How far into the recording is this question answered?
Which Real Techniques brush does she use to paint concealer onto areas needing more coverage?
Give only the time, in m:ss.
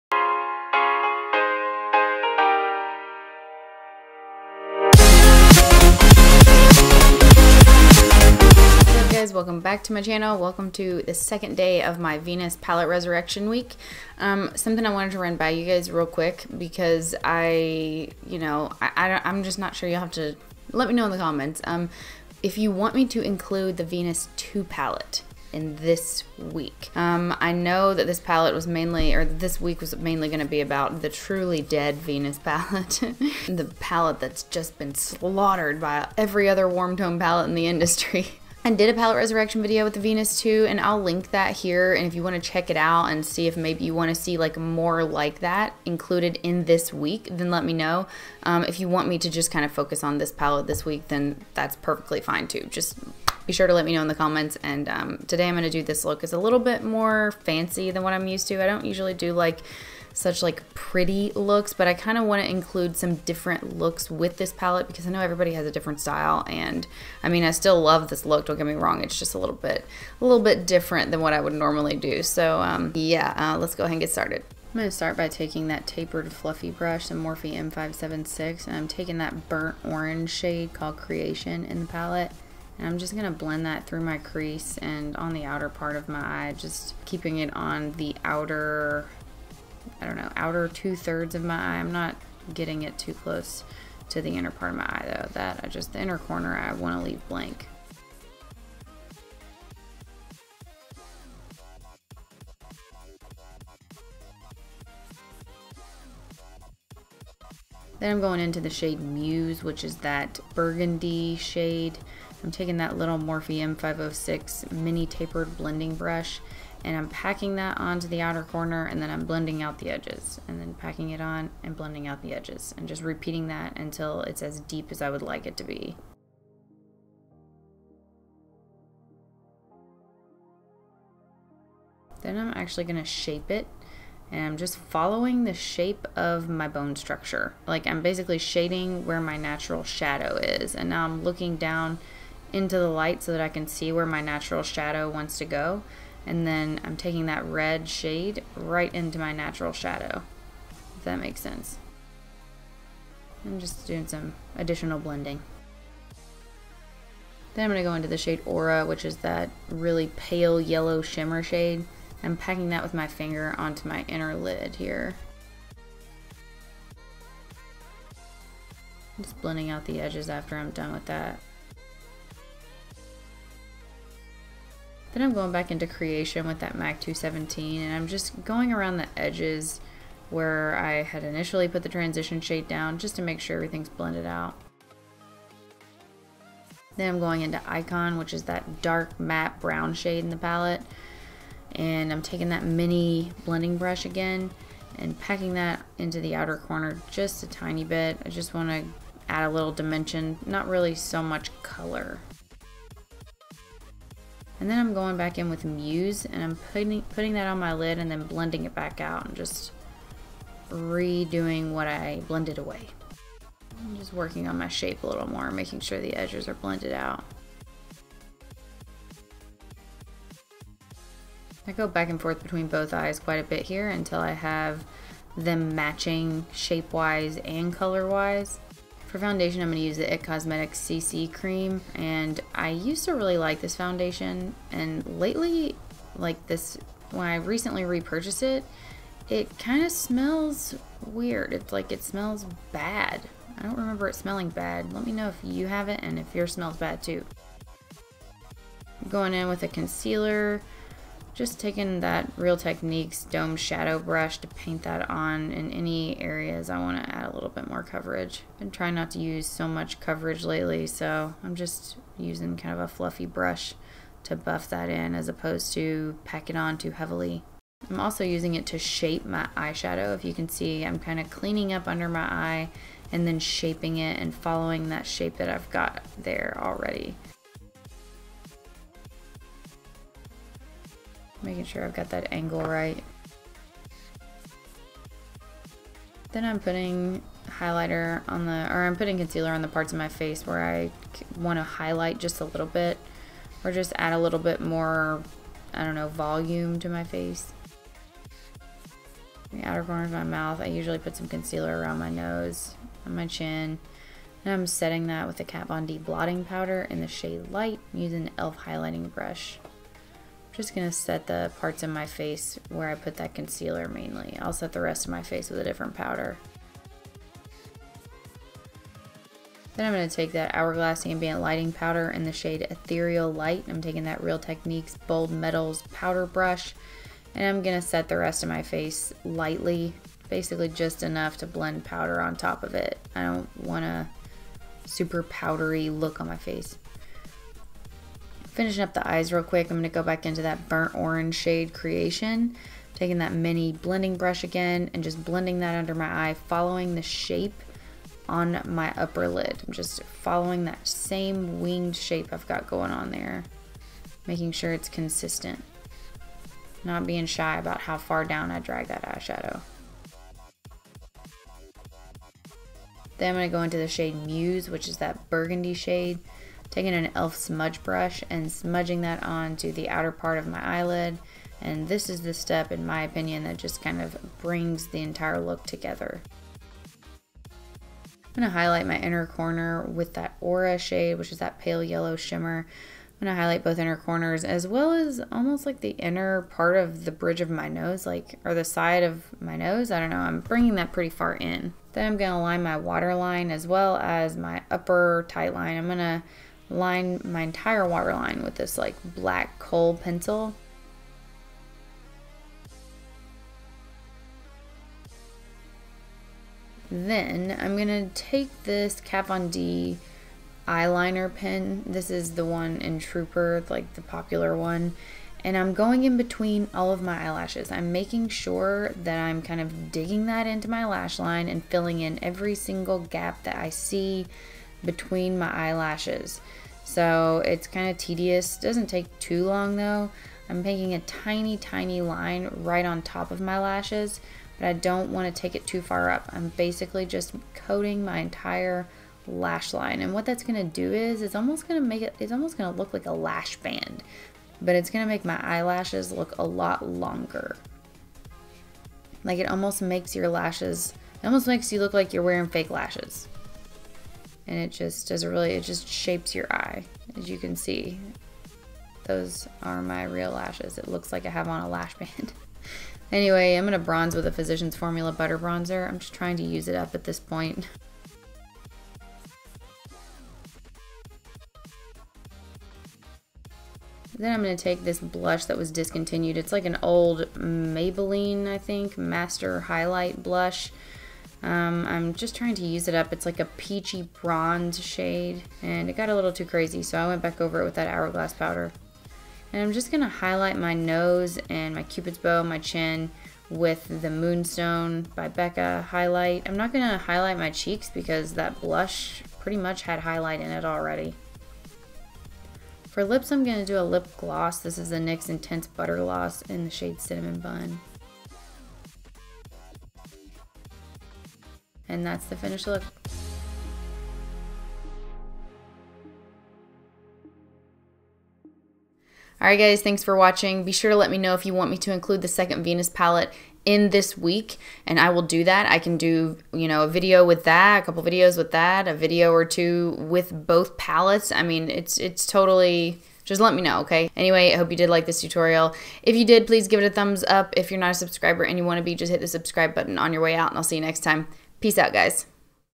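4:13.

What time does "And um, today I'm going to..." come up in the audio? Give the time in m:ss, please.
0:54.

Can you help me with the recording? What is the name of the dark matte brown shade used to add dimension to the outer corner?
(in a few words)
Icon.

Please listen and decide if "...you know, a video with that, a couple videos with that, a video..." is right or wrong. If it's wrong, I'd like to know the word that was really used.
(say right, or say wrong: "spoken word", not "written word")
right.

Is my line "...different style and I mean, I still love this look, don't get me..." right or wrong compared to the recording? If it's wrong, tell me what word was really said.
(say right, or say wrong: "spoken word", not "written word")
right.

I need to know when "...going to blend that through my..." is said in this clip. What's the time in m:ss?
1:23.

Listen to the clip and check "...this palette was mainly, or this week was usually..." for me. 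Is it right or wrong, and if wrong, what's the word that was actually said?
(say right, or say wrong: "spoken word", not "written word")
wrong: "mainly", not "usually".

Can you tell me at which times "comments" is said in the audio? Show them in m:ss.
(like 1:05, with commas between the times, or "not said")
0:21, 0:54.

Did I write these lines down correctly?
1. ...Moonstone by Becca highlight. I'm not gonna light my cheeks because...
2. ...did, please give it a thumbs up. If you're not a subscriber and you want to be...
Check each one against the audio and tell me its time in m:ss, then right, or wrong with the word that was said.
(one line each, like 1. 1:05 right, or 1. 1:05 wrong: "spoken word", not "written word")
1. 8:14 wrong: "highlight", not "light"
2. 8:56 right.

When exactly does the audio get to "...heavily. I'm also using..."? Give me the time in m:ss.
4:26.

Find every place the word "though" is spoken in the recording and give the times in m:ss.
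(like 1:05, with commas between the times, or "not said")
1:35, 7:09.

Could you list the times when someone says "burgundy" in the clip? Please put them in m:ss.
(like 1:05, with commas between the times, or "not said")
1:50, 6:05.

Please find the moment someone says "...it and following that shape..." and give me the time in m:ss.
4:33.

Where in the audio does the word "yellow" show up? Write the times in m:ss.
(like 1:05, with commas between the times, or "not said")
2:40, 6:21.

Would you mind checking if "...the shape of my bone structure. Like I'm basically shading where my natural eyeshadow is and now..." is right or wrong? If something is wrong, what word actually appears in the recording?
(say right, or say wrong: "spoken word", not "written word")
wrong: "shadow", not "eyeshadow".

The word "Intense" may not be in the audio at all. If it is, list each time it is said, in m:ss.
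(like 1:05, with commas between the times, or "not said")
8:25.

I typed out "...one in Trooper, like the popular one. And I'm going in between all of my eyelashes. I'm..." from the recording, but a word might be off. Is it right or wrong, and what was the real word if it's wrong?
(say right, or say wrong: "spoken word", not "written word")
right.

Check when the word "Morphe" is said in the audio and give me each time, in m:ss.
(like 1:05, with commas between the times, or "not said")
1:17, 1:53.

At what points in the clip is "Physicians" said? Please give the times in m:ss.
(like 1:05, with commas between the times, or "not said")
7:44.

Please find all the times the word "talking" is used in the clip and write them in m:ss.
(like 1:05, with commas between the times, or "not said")
not said.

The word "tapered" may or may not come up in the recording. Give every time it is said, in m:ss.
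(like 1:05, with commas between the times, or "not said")
1:15, 1:55.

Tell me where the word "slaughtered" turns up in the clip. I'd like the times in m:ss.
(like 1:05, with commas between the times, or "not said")
0:34.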